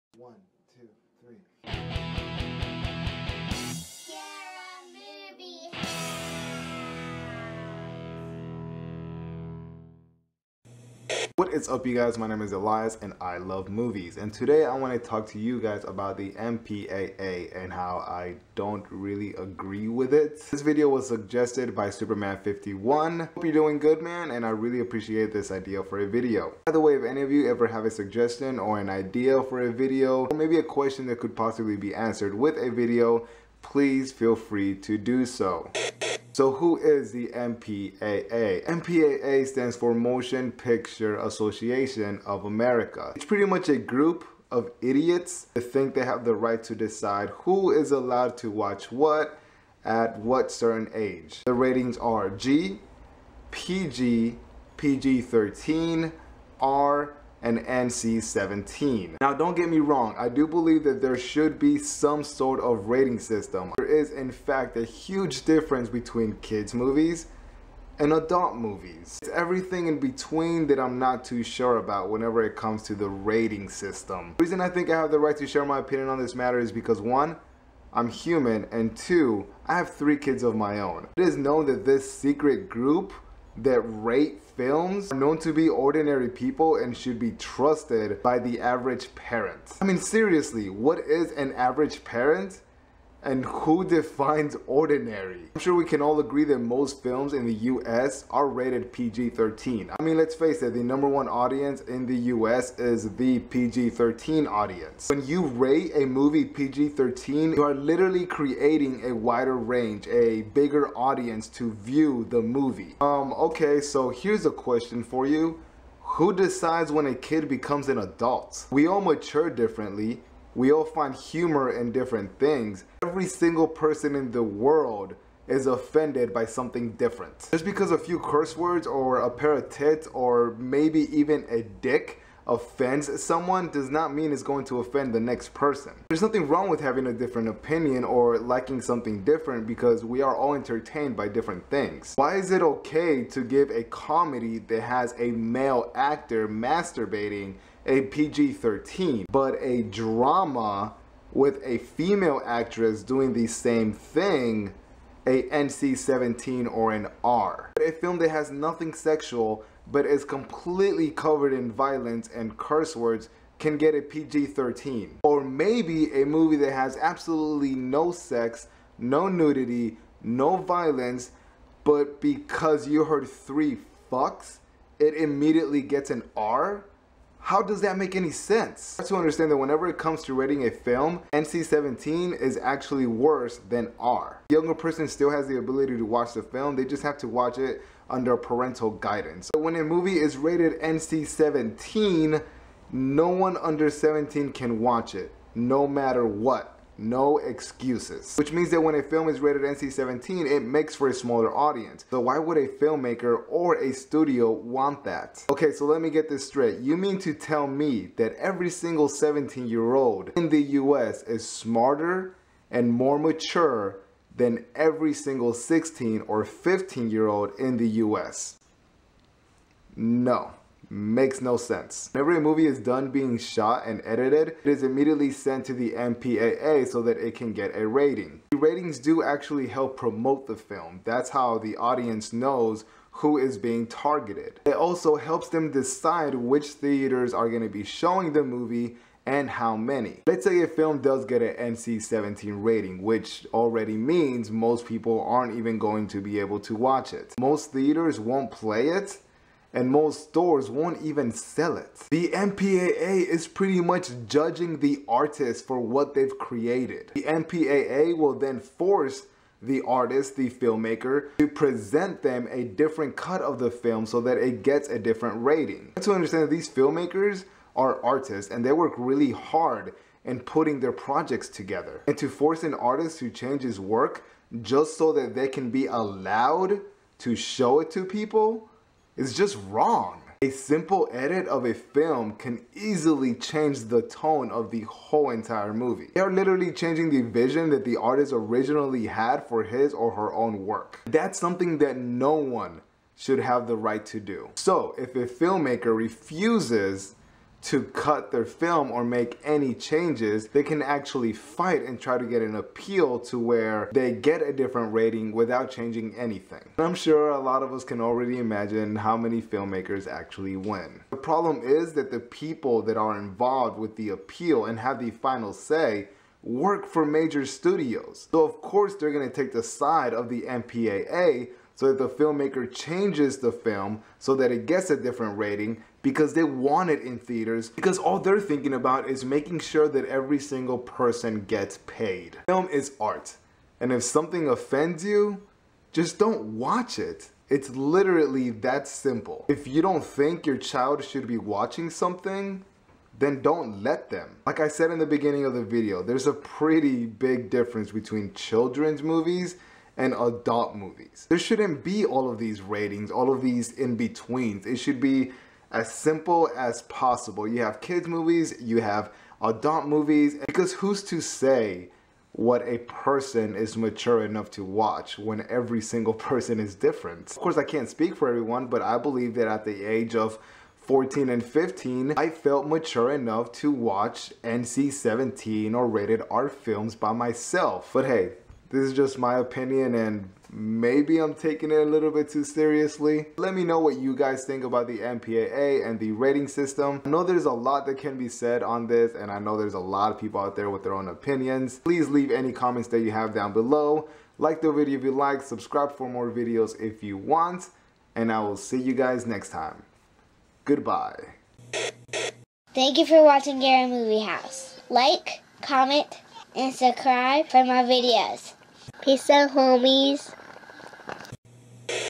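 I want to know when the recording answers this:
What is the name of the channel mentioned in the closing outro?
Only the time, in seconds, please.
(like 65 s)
403 s.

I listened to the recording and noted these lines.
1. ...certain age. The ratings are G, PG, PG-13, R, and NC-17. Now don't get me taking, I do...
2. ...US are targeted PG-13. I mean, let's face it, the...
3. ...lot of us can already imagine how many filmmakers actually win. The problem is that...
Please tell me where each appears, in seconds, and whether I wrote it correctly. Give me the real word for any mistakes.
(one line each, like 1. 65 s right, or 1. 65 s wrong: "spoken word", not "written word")
1. 50 s wrong: "wrong", not "taking"
2. 97 s wrong: "rated", not "targeted"
3. 307 s right.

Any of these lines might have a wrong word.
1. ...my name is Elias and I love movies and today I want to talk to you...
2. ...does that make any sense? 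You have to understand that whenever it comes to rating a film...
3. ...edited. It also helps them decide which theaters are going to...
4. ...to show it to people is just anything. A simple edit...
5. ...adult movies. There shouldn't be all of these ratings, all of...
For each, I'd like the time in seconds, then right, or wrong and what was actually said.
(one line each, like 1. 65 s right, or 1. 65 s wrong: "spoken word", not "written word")
1. 12 s right
2. 177 s right
3. 233 s wrong: "targeted", not "edited"
4. 277 s wrong: "wrong", not "anything"
5. 350 s right.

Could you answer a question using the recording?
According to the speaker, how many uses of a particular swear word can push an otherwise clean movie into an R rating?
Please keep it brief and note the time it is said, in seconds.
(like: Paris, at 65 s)
3, at 173 s.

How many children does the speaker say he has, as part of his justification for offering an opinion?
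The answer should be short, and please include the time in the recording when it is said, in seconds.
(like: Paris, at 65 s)
3, at 79 s.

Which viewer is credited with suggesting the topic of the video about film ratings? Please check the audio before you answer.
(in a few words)
Superman51.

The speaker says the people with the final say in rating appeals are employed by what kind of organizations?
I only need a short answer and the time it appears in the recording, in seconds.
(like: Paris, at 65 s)
major studios, at 317 s.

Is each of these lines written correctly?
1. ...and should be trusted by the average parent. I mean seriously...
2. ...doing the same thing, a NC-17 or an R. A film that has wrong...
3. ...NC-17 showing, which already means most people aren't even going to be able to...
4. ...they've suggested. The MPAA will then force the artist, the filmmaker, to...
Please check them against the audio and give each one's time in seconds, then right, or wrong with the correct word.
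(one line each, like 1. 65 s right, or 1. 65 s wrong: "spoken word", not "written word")
1. 86 s right
2. 153 s wrong: "nothing", not "wrong"
3. 241 s wrong: "rating", not "showing"
4. 256 s wrong: "created", not "suggested".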